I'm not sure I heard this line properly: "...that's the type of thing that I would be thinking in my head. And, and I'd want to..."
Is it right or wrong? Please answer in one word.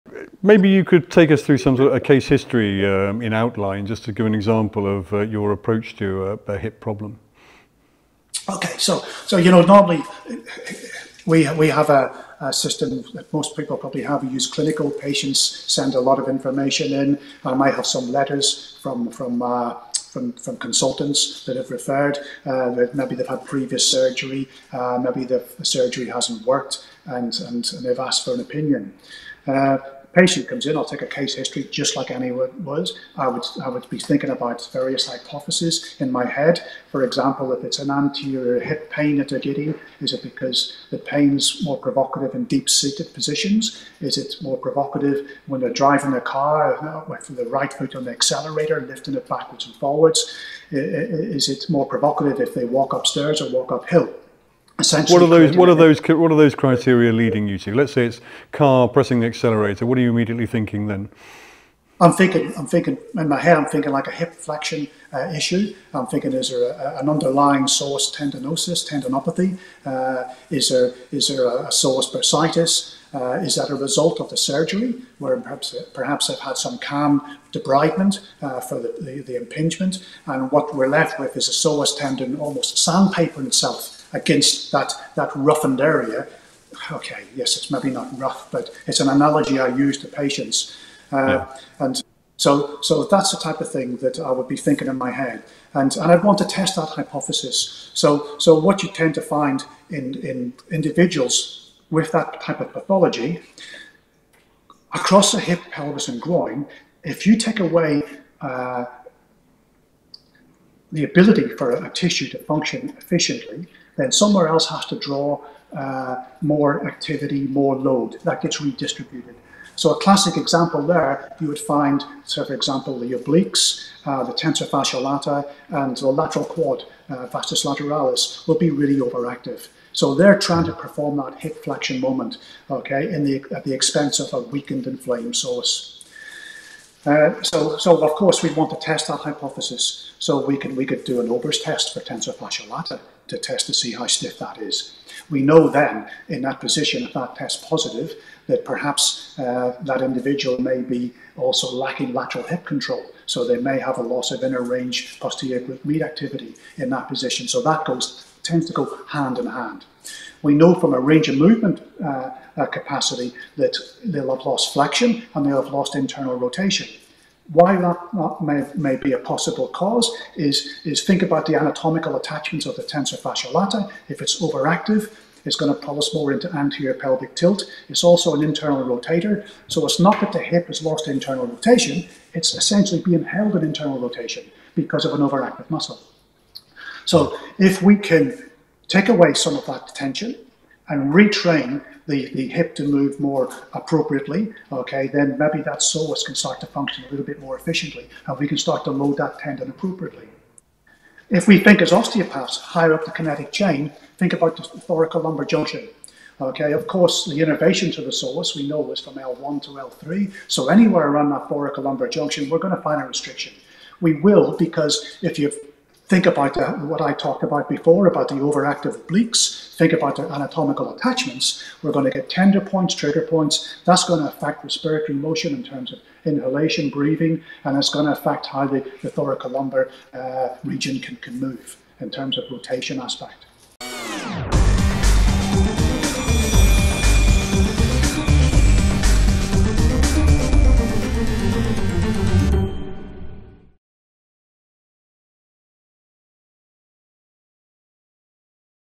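right.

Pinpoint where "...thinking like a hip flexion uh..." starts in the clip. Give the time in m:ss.
1:03.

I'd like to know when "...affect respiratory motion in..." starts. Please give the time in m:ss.
3:44.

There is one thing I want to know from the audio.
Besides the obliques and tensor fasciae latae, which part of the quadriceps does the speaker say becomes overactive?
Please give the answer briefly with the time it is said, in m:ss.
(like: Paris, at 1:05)
Vastus lateralis, at 2:07.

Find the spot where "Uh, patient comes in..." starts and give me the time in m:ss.
0:29.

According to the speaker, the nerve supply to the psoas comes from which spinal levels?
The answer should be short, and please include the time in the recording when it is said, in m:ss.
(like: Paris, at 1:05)
L1 to L3, at 3:29.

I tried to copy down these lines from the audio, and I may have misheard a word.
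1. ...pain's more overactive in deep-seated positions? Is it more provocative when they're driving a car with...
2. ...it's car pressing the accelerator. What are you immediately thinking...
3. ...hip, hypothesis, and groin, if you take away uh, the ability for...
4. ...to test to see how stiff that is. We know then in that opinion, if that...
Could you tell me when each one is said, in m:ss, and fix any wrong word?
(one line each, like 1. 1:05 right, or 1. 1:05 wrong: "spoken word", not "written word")
1. 0:40 wrong: "provocative", not "overactive"
2. 0:58 right
3. 1:45 wrong: "pelvis", not "hypothesis"
4. 2:23 wrong: "position", not "opinion".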